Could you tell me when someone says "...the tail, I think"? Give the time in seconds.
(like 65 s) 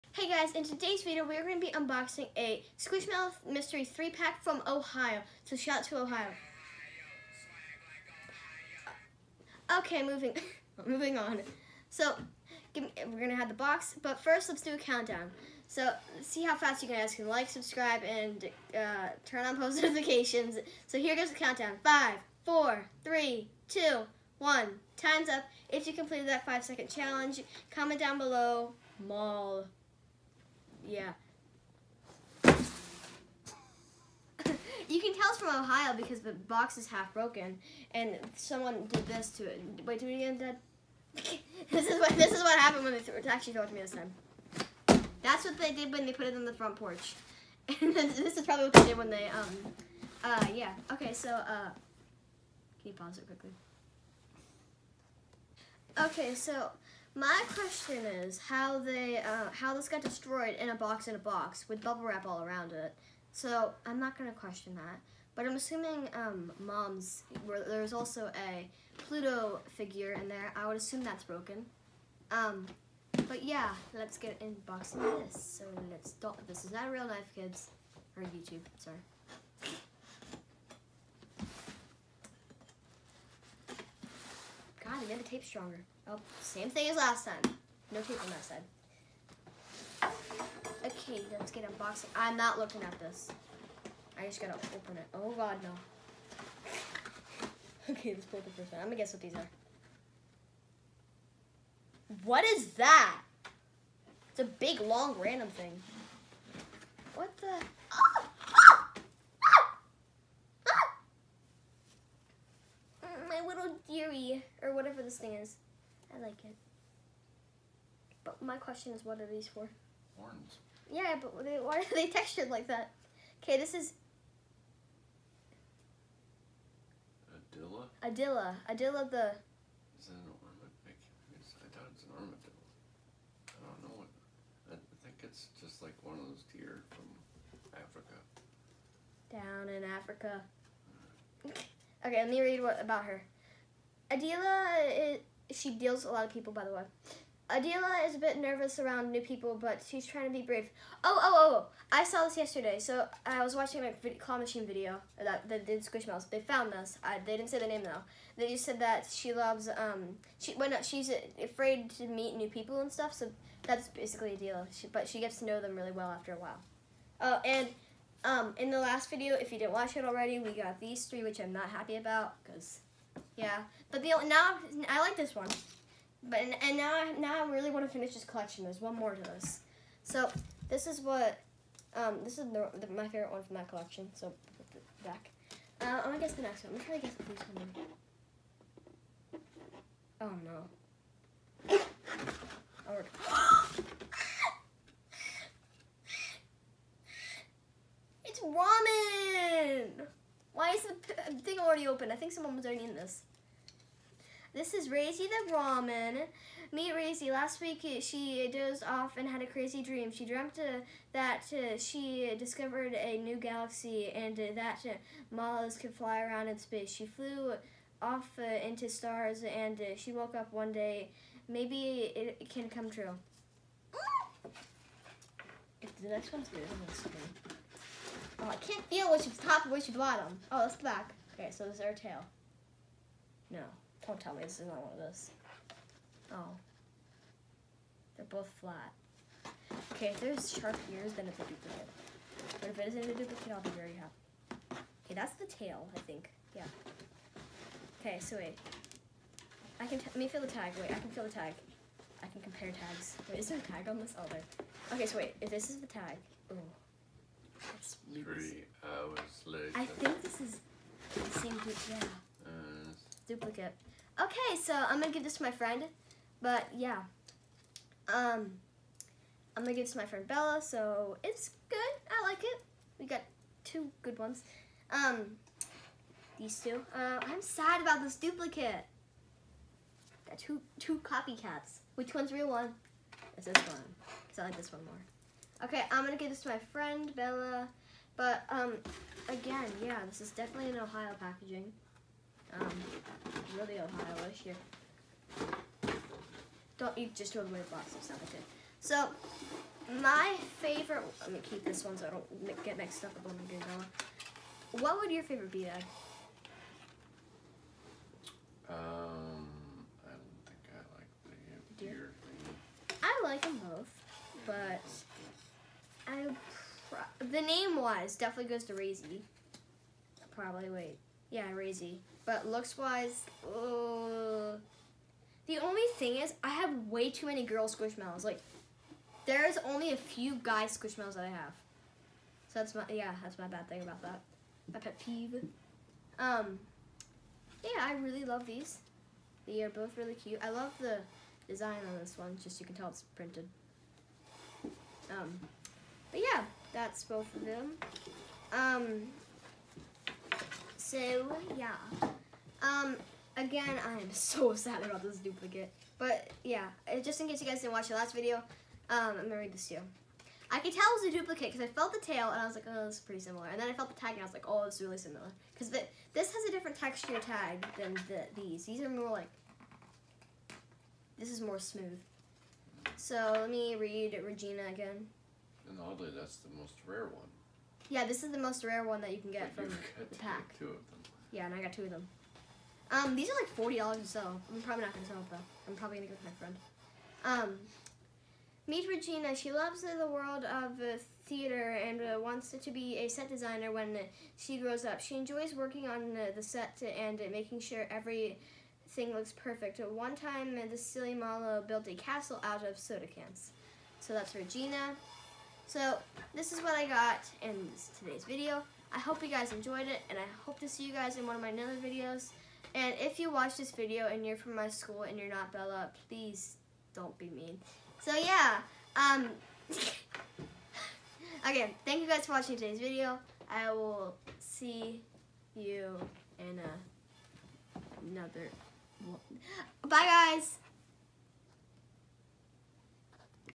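245 s.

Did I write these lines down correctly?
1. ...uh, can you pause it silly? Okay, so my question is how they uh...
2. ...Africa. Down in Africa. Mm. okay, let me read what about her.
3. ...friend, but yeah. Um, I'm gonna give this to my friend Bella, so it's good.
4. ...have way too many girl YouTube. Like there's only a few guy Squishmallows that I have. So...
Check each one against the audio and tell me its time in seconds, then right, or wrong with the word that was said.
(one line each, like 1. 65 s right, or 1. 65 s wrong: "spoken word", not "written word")
1. 51 s wrong: "quickly", not "silly"
2. 137 s right
3. 265 s right
4. 326 s wrong: "Squishmallows", not "YouTube".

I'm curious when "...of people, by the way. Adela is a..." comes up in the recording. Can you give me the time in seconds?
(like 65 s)
146 s.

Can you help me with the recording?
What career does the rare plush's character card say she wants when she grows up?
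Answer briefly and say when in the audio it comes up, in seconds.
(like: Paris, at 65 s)
Set designer, at 393 s.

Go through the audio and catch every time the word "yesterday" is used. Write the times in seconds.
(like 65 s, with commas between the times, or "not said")
152 s.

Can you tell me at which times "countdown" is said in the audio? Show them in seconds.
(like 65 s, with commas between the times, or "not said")
14 s, 21 s.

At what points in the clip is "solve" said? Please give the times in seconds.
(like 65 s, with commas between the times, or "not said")
not said.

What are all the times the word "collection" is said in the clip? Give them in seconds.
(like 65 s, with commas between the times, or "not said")
178 s, 183 s.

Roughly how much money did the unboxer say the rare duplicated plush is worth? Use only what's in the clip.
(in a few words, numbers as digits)
$40.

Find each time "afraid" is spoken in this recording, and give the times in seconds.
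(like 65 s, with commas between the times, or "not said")
161 s.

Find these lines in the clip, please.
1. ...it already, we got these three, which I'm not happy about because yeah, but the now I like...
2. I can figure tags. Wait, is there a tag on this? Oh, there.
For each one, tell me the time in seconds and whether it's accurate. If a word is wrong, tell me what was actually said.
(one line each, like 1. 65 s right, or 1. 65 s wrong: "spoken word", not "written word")
1. 169 s right
2. 252 s wrong: "compare", not "figure".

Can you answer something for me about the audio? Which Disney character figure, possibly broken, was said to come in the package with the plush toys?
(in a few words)
Pluto.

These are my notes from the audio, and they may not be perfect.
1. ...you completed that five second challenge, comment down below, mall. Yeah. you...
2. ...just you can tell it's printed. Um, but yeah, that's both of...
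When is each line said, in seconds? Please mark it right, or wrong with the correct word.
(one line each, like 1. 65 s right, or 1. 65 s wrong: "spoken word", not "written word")
1. 25 s right
2. 342 s right.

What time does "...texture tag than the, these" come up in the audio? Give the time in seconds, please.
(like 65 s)
366 s.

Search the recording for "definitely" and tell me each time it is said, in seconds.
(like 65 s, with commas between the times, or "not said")
290 s, 318 s.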